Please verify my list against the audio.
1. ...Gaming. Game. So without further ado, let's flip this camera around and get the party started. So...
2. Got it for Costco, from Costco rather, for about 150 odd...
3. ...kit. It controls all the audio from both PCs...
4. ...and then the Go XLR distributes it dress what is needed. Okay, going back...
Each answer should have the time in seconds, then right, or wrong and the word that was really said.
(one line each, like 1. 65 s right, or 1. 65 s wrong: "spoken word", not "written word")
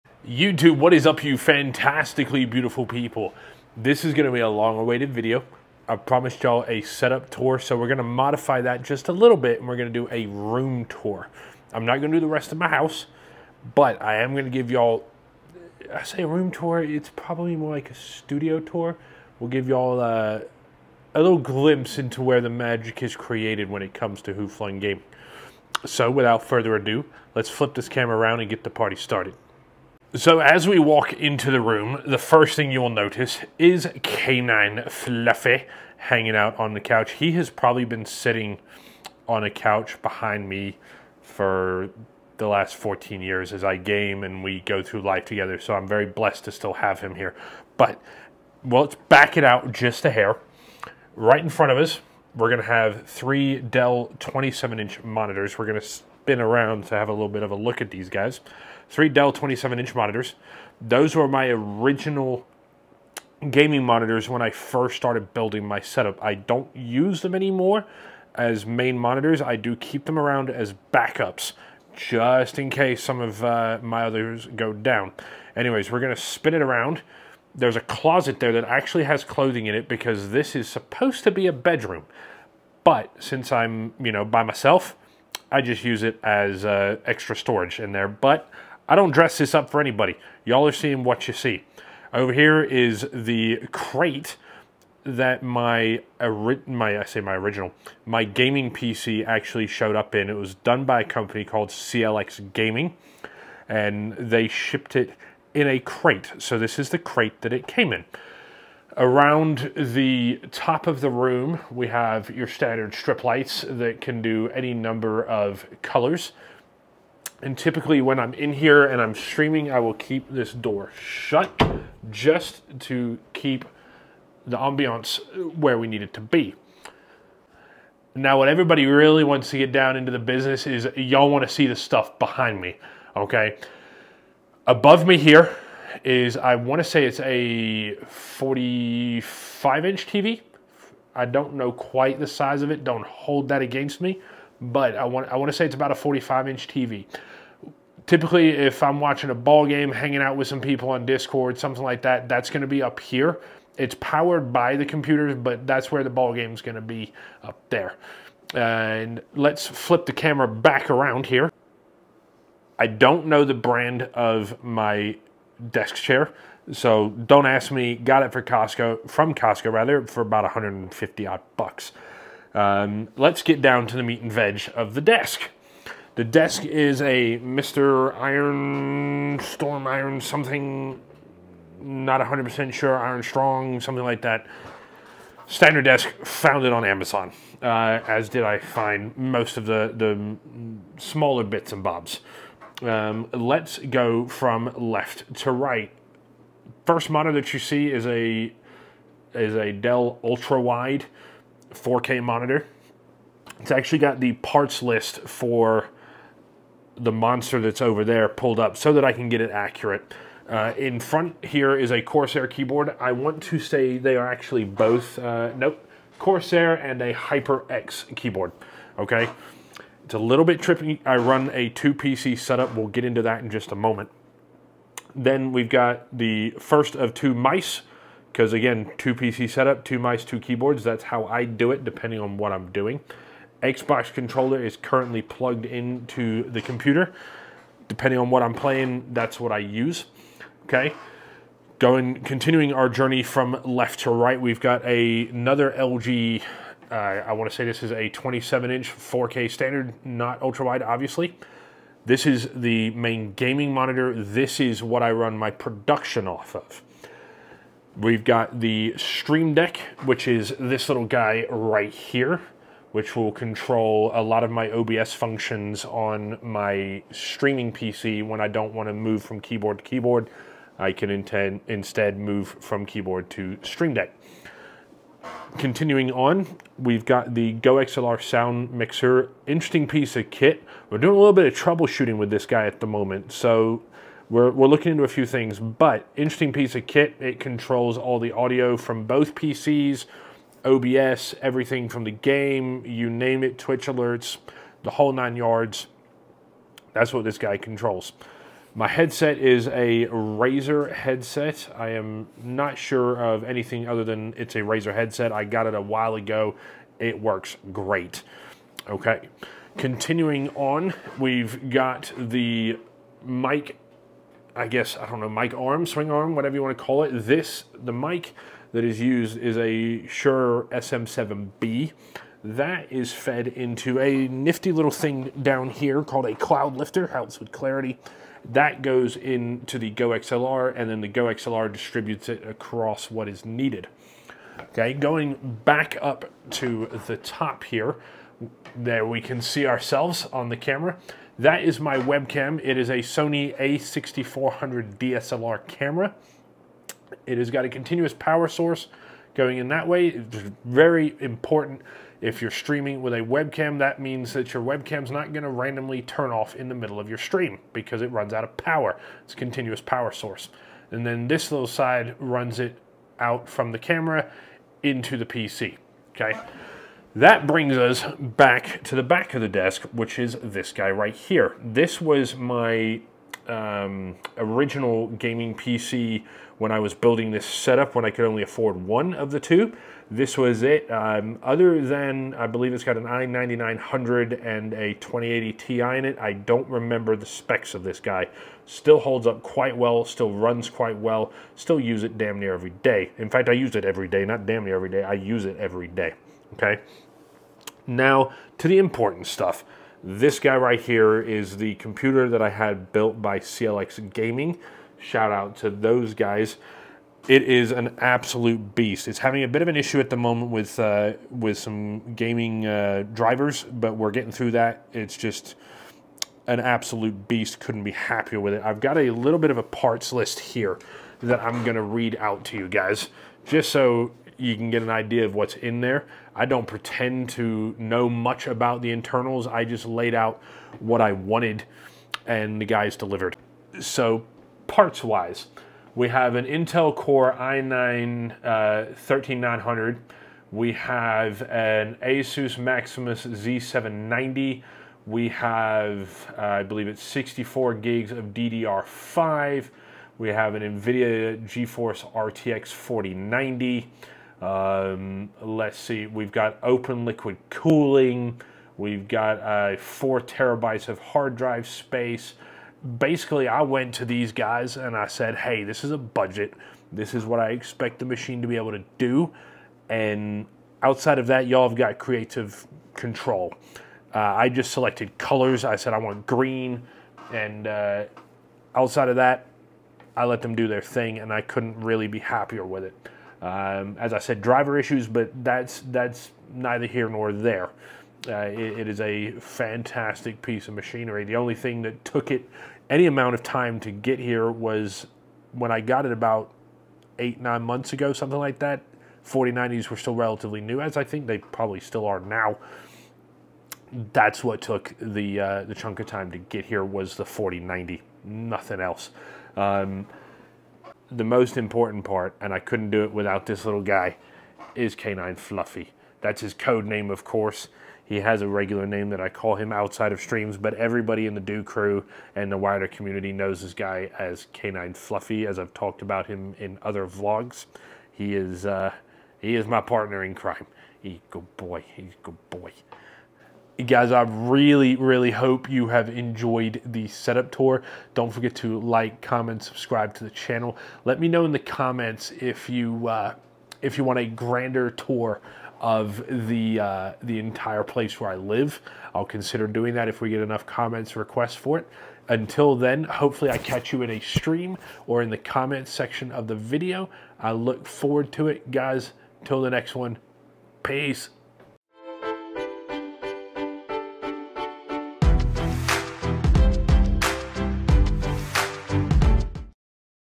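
1. 24 s right
2. 167 s right
3. 286 s right
4. 330 s wrong: "across", not "dress".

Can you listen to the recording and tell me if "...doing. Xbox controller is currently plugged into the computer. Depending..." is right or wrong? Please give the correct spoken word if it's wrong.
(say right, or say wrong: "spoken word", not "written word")
right.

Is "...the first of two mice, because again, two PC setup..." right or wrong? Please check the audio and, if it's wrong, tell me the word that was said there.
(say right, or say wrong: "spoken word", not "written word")
right.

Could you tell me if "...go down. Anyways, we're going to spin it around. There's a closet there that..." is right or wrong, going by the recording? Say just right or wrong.
right.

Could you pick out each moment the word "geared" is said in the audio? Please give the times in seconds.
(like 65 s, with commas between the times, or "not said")
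not said.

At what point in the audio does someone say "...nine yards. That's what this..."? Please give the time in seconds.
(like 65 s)
295 s.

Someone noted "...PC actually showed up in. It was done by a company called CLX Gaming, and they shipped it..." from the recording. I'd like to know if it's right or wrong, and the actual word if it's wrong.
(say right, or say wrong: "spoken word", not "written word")
right.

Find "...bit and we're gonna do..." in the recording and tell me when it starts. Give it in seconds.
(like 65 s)
9 s.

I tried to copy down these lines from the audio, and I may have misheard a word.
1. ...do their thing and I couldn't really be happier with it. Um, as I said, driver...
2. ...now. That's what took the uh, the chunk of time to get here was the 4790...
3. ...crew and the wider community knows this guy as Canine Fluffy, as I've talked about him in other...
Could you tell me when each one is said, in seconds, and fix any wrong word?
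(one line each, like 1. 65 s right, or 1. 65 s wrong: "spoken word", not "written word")
1. 480 s right
2. 502 s wrong: "4090", not "4790"
3. 521 s right.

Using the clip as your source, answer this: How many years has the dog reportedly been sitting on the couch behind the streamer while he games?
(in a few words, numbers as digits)
14.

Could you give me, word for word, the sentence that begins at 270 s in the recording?
I can intend, instead move from keyboard to Stream Deck continuing on, we've got the Go XLR sound mixer.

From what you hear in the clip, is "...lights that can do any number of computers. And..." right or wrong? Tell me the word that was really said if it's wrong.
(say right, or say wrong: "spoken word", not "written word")
wrong: "colors", not "computers".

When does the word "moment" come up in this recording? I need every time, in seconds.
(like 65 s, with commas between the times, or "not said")
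223 s, 282 s, 410 s.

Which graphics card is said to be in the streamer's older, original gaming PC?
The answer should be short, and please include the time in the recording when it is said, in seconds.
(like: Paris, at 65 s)
2080 Ti, at 384 s.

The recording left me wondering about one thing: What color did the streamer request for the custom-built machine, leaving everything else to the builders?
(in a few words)
Green.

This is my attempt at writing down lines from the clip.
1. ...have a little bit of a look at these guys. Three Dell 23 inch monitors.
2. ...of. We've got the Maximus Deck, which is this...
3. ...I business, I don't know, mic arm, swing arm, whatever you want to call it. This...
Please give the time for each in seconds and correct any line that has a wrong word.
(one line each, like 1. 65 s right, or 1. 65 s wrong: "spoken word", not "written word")
1. 56 s wrong: "27", not "23"
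2. 256 s wrong: "Stream", not "Maximus"
3. 314 s wrong: "guess", not "business".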